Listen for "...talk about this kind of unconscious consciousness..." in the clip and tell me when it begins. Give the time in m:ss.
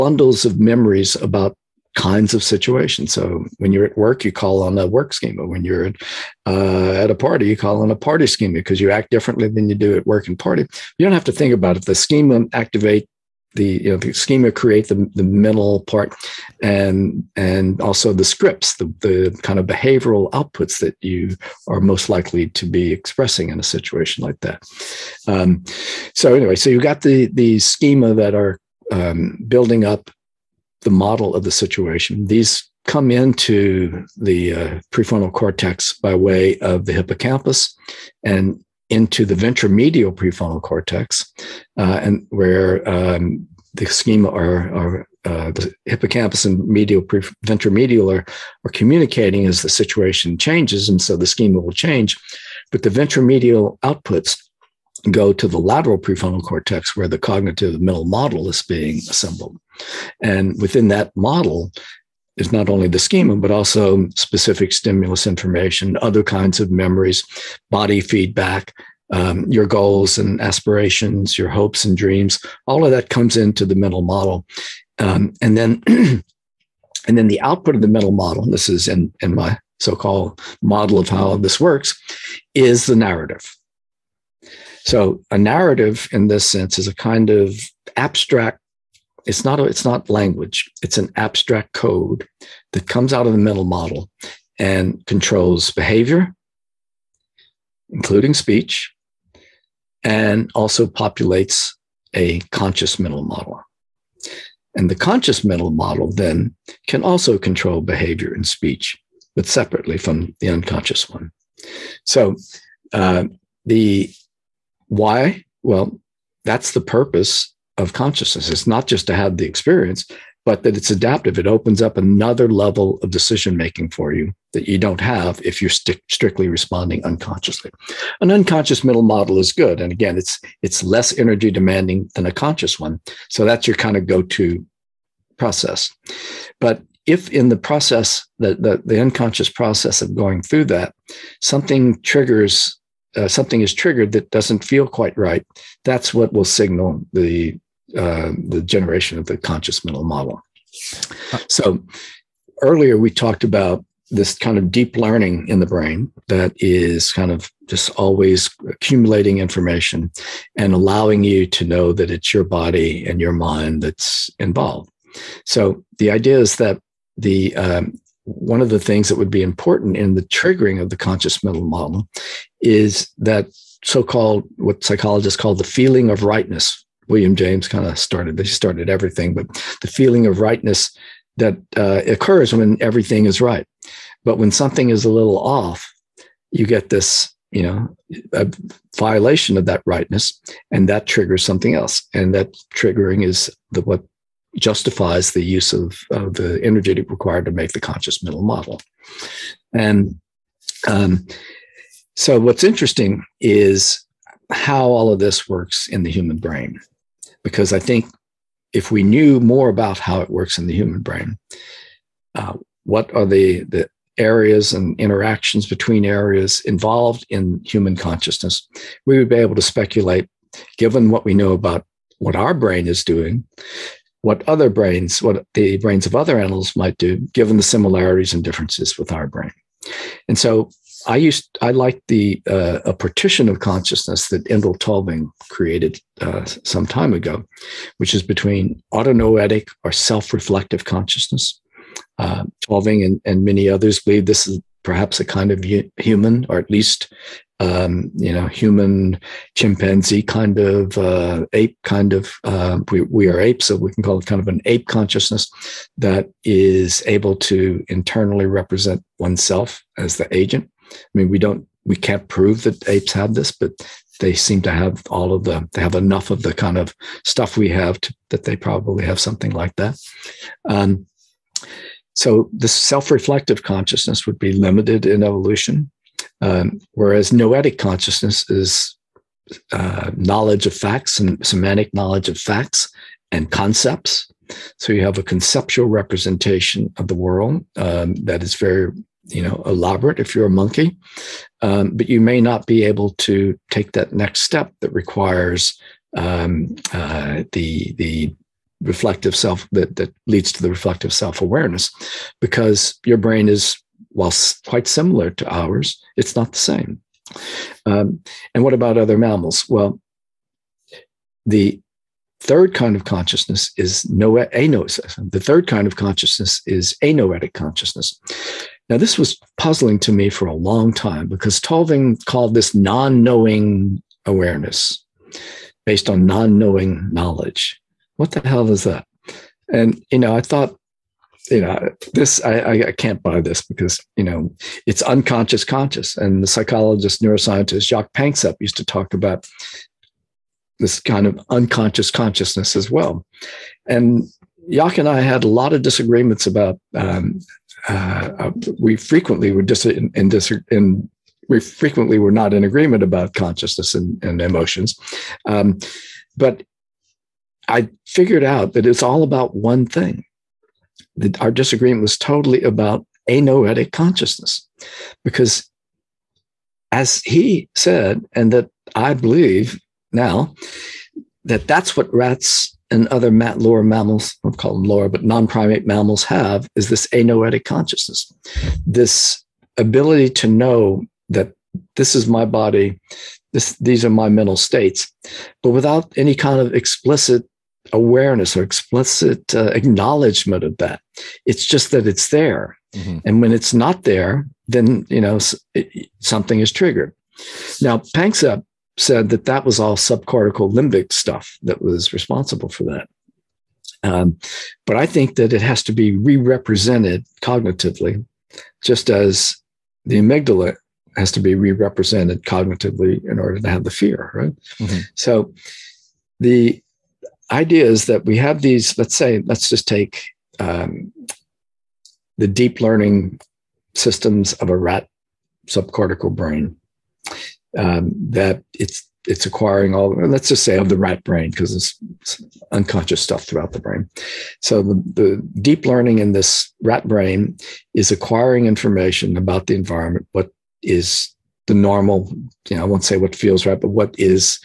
5:38.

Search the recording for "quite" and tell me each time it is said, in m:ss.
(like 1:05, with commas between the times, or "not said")
2:24, 5:04.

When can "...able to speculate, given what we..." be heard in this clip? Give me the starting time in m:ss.
3:39.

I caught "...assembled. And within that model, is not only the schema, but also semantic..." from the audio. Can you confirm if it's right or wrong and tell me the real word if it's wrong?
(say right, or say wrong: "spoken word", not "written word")
wrong: "specific", not "semantic".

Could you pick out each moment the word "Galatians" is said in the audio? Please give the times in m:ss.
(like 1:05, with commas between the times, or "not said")
not said.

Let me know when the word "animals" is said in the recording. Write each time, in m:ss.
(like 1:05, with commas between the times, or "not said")
3:46.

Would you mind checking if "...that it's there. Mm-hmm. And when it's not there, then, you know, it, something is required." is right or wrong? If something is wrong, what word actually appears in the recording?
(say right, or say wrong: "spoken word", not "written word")
wrong: "triggered", not "required".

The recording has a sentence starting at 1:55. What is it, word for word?
Well, that's the purpose of consciousness.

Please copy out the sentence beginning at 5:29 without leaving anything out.
And, you know, I thought, you know, this, I, I can't buy this because, you know, it's unconscious conscious.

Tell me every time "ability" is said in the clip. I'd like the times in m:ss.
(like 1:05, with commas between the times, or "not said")
6:19.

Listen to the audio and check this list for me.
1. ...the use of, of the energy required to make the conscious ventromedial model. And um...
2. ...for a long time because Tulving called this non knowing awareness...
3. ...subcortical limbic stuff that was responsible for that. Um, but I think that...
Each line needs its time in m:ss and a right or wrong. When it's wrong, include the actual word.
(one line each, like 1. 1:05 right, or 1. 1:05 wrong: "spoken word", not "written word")
1. 3:15 wrong: "mental", not "ventromedial"
2. 5:20 right
3. 6:39 right.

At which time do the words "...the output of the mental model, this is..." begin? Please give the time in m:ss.
1:17.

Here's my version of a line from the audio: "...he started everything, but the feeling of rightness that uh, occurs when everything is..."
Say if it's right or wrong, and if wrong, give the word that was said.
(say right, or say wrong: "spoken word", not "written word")
right.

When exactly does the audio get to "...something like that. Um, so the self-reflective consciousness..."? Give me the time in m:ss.
4:29.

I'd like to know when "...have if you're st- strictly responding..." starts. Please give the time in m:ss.
2:05.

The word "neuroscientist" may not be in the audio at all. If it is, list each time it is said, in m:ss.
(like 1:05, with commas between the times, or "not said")
5:37.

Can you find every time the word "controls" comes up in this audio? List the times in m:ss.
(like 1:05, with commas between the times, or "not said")
1:35, 1:47.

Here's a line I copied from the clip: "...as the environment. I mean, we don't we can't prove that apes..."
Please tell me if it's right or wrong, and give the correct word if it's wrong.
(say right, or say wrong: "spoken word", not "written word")
wrong: "agent", not "environment".